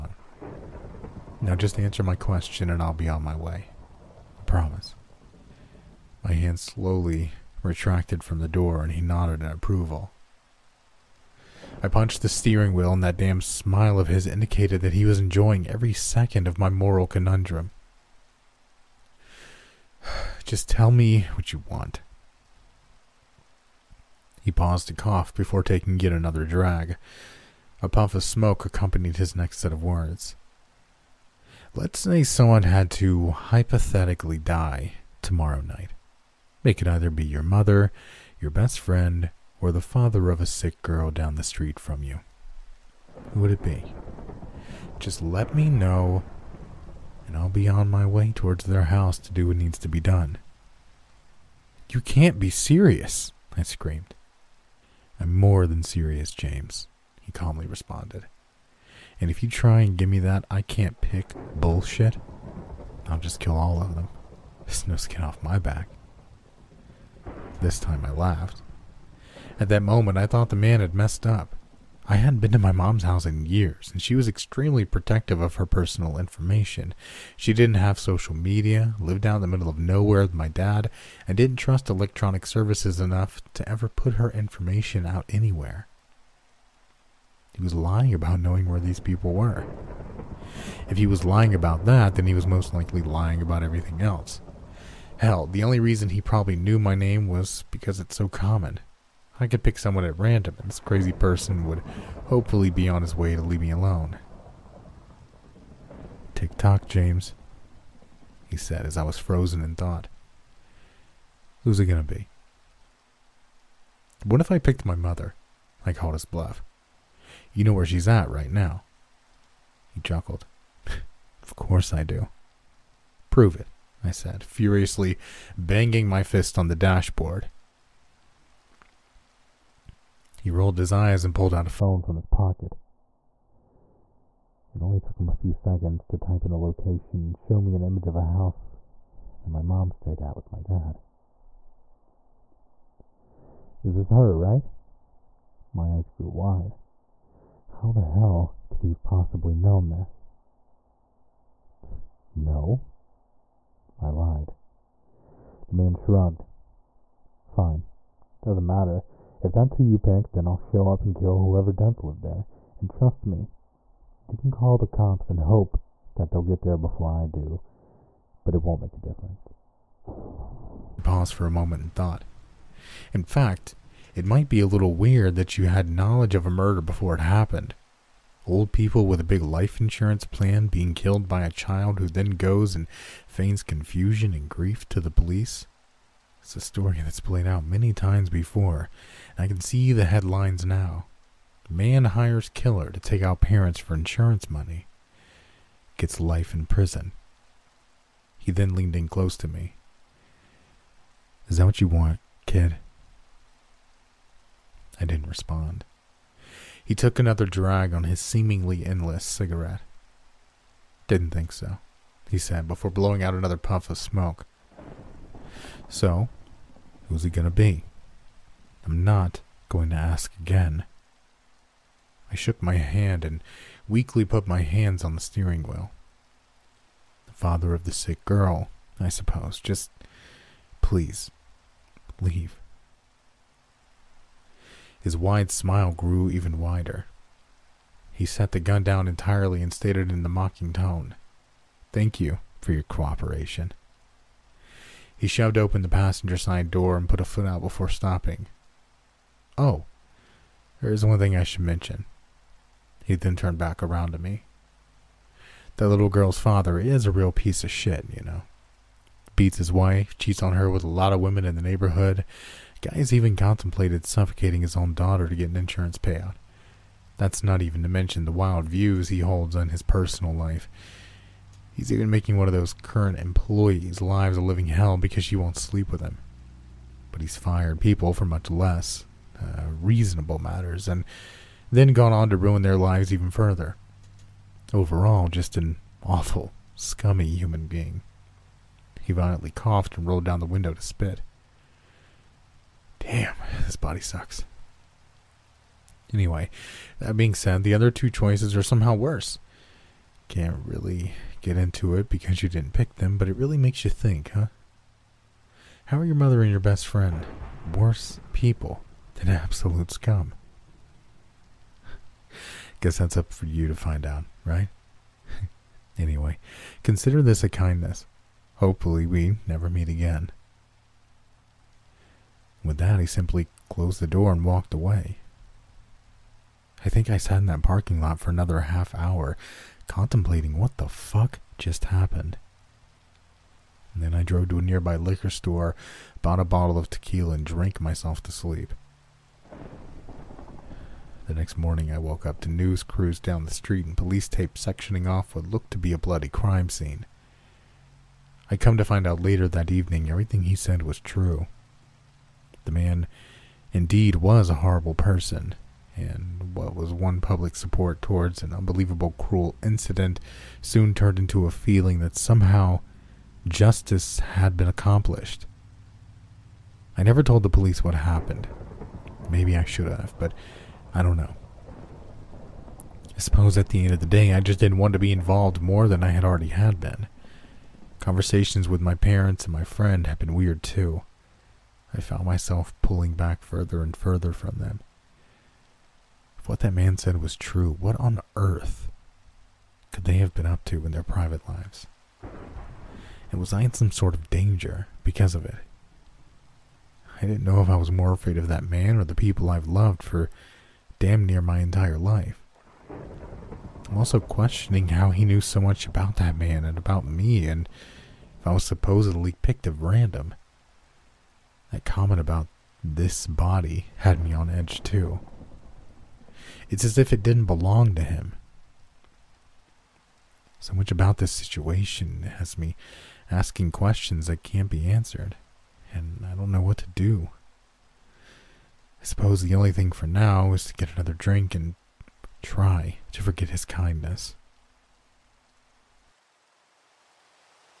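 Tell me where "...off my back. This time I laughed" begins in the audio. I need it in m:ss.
1:05.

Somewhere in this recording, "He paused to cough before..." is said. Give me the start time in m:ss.
0:24.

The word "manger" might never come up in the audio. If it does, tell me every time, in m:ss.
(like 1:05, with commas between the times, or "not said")
not said.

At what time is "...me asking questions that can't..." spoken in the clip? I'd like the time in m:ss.
7:02.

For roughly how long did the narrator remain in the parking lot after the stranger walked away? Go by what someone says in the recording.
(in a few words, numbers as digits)
half hour.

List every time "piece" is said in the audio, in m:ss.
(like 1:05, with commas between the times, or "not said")
4:17.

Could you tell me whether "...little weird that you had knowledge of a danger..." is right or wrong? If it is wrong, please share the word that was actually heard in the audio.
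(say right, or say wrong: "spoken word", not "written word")
wrong: "murder", not "danger".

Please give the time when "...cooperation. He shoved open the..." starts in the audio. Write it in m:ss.
4:02.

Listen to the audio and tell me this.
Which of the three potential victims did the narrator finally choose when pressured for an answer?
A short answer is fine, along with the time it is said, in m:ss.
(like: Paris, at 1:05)
the father of the sick girl, at 3:47.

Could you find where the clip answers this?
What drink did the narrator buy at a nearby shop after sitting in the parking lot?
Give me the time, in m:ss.
5:36.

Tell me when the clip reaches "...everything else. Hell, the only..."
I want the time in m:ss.
1:33.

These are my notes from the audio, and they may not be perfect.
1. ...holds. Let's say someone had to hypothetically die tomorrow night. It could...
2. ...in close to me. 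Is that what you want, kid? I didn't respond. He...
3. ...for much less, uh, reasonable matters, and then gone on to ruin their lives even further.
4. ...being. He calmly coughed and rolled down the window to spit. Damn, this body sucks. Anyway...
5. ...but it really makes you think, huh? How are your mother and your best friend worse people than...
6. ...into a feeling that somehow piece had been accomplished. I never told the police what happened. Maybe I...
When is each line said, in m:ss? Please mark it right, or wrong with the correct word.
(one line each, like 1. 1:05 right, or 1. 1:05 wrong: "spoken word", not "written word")
1. 0:29 wrong: "words", not "holds"
2. 3:18 right
3. 4:38 right
4. 4:47 wrong: "violently", not "calmly"
5. 5:03 right
6. 6:01 wrong: "justice", not "piece".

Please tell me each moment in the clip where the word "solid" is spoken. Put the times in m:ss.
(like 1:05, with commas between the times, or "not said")
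not said.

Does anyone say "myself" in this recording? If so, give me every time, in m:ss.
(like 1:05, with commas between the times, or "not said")
5:37, 6:22.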